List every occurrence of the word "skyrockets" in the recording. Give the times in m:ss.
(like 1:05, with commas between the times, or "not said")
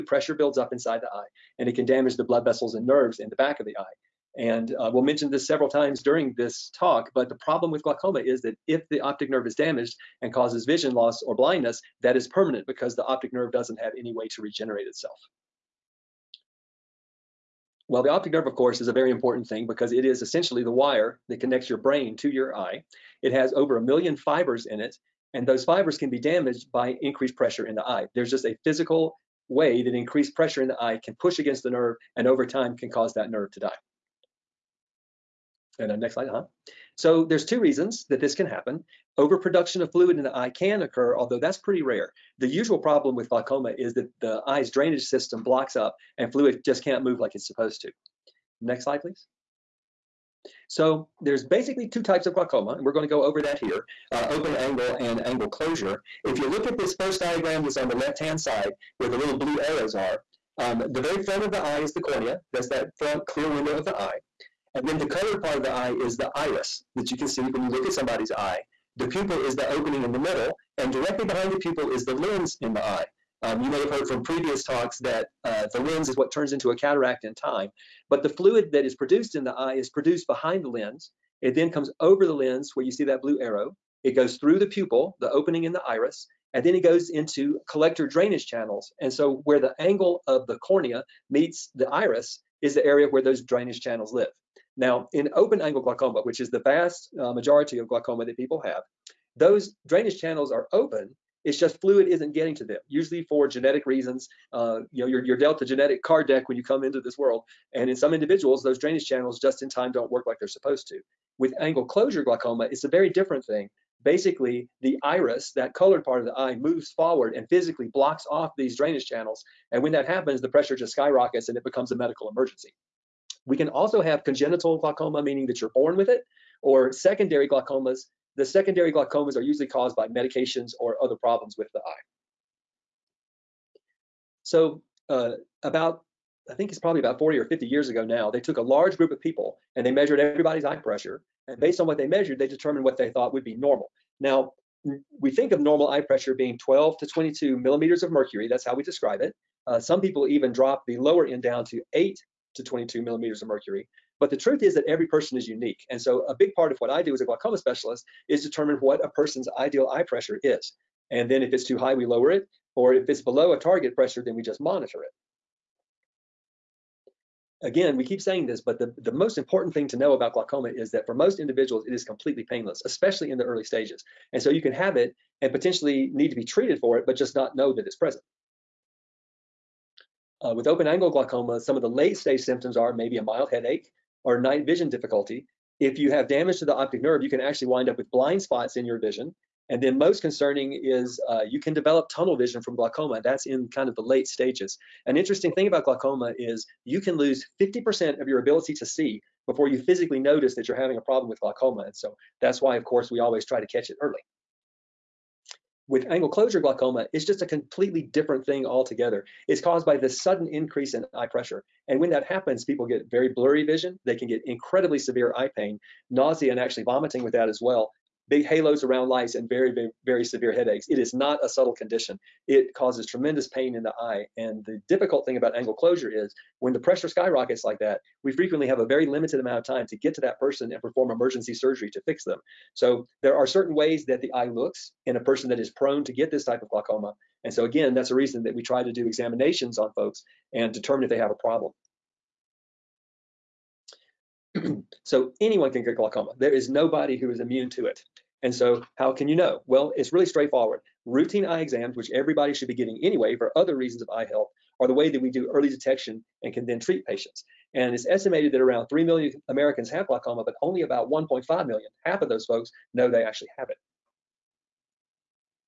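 2:00, 3:47.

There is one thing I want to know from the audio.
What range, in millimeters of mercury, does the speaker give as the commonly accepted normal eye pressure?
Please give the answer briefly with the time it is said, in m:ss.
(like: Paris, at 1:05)
12 to 22, at 2:26.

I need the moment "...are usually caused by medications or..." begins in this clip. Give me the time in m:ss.
2:09.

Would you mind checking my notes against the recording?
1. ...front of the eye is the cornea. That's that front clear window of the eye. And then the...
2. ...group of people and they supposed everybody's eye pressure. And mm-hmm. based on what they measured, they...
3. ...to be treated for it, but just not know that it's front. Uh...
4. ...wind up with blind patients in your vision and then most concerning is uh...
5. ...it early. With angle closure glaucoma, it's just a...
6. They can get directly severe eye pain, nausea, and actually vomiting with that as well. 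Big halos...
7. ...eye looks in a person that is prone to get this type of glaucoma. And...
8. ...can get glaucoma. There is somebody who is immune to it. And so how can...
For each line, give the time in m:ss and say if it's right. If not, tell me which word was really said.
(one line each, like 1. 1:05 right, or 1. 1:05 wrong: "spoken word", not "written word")
1. 1:01 right
2. 2:18 wrong: "measured", not "supposed"
3. 2:56 wrong: "present", not "front"
4. 3:07 wrong: "spots", not "patients"
5. 3:23 right
6. 3:34 wrong: "incredibly", not "directly"
7. 3:54 right
8. 4:05 wrong: "nobody", not "somebody".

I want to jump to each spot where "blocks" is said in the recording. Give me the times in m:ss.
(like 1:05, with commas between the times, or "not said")
0:45, 1:57.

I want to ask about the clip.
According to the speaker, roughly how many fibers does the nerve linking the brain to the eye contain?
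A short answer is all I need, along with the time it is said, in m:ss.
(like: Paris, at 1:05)
over a million, at 0:23.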